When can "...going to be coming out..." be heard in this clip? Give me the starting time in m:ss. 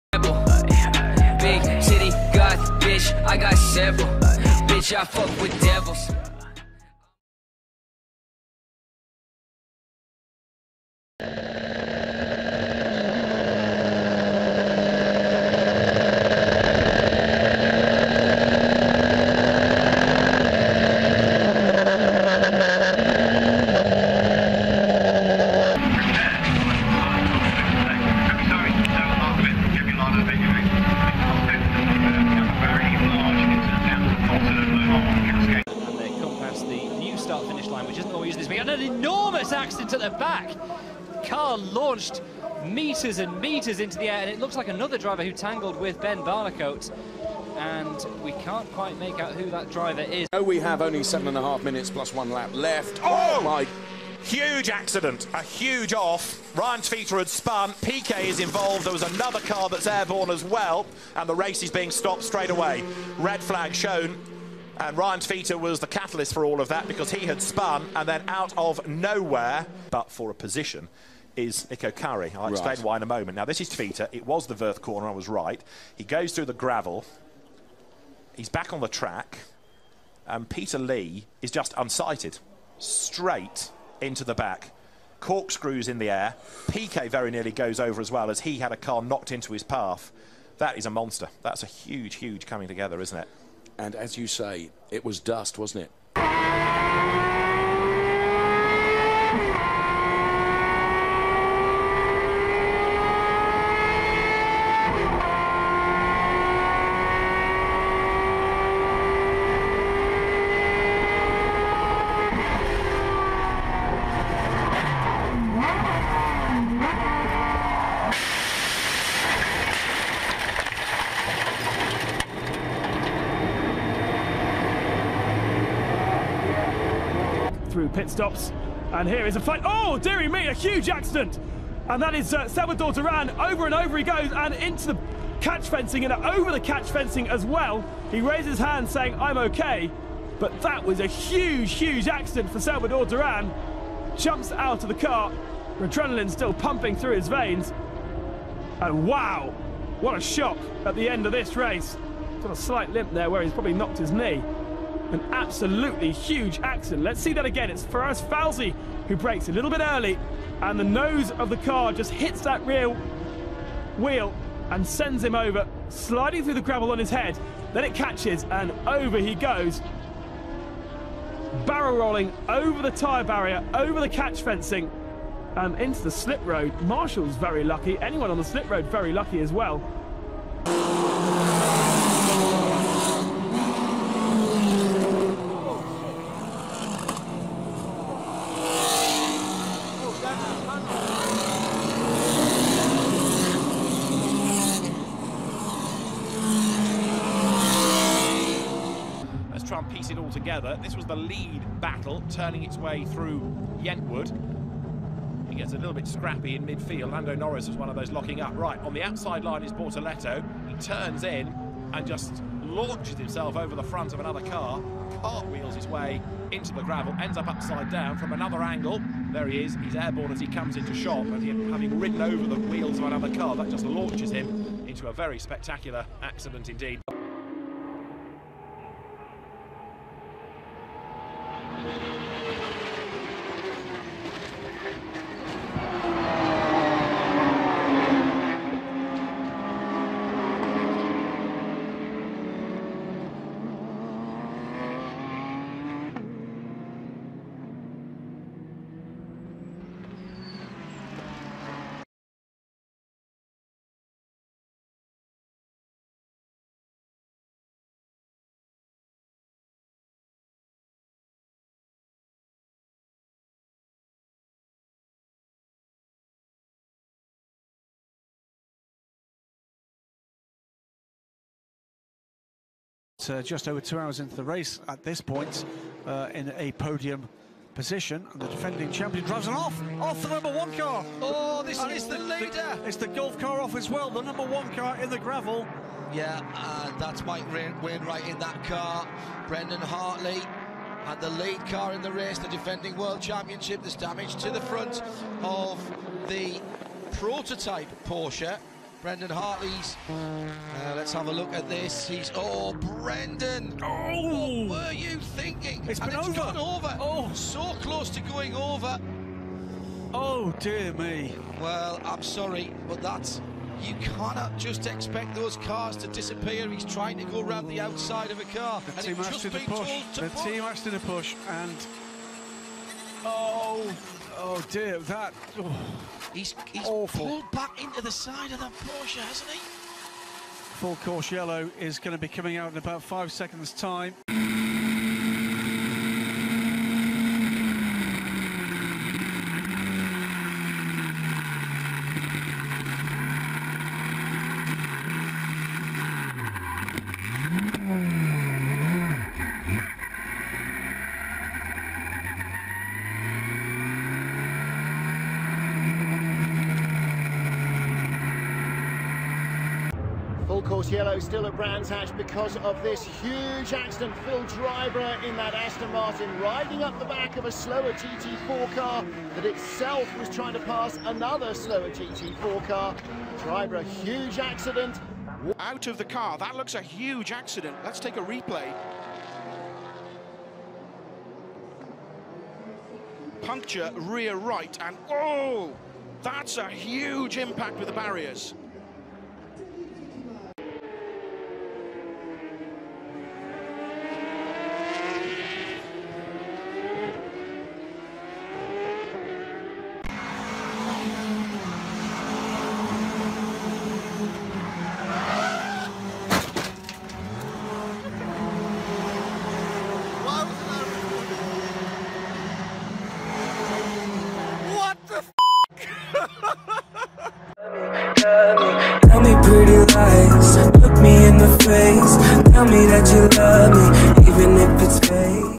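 5:31.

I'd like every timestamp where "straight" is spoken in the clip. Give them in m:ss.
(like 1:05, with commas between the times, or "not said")
1:02, 1:22.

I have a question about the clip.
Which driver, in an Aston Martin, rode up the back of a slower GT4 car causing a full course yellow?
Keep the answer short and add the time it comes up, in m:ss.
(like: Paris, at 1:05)
Phil Driver, at 6:04.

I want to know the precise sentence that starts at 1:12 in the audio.
I'll explain why in a moment.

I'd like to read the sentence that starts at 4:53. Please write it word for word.
There's damage to the front of the prototype Porsche.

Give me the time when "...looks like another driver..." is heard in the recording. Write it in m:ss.
0:44.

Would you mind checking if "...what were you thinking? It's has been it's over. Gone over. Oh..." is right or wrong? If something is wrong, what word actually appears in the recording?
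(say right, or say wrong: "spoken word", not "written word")
right.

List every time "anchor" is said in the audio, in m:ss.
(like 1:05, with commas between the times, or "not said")
not said.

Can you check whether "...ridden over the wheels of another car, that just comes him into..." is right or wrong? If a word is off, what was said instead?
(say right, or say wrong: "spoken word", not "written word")
wrong: "launches", not "comes".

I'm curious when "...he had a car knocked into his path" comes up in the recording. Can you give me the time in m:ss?
1:28.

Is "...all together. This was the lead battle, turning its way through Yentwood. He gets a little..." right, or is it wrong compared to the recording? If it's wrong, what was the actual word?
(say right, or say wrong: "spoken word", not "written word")
right.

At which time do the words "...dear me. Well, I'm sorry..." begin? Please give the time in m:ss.
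5:10.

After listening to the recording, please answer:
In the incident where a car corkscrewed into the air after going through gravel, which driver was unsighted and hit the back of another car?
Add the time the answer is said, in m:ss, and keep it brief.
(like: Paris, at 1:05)
Peter Lee, at 1:20.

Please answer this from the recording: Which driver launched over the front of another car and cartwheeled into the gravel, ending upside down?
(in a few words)
Bortoletto.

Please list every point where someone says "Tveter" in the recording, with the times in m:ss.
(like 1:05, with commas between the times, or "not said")
0:56, 1:05.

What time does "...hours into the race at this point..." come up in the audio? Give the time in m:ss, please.
4:33.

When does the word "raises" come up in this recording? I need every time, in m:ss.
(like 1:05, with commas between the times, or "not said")
2:18.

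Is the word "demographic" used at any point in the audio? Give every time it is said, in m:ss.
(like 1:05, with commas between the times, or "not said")
not said.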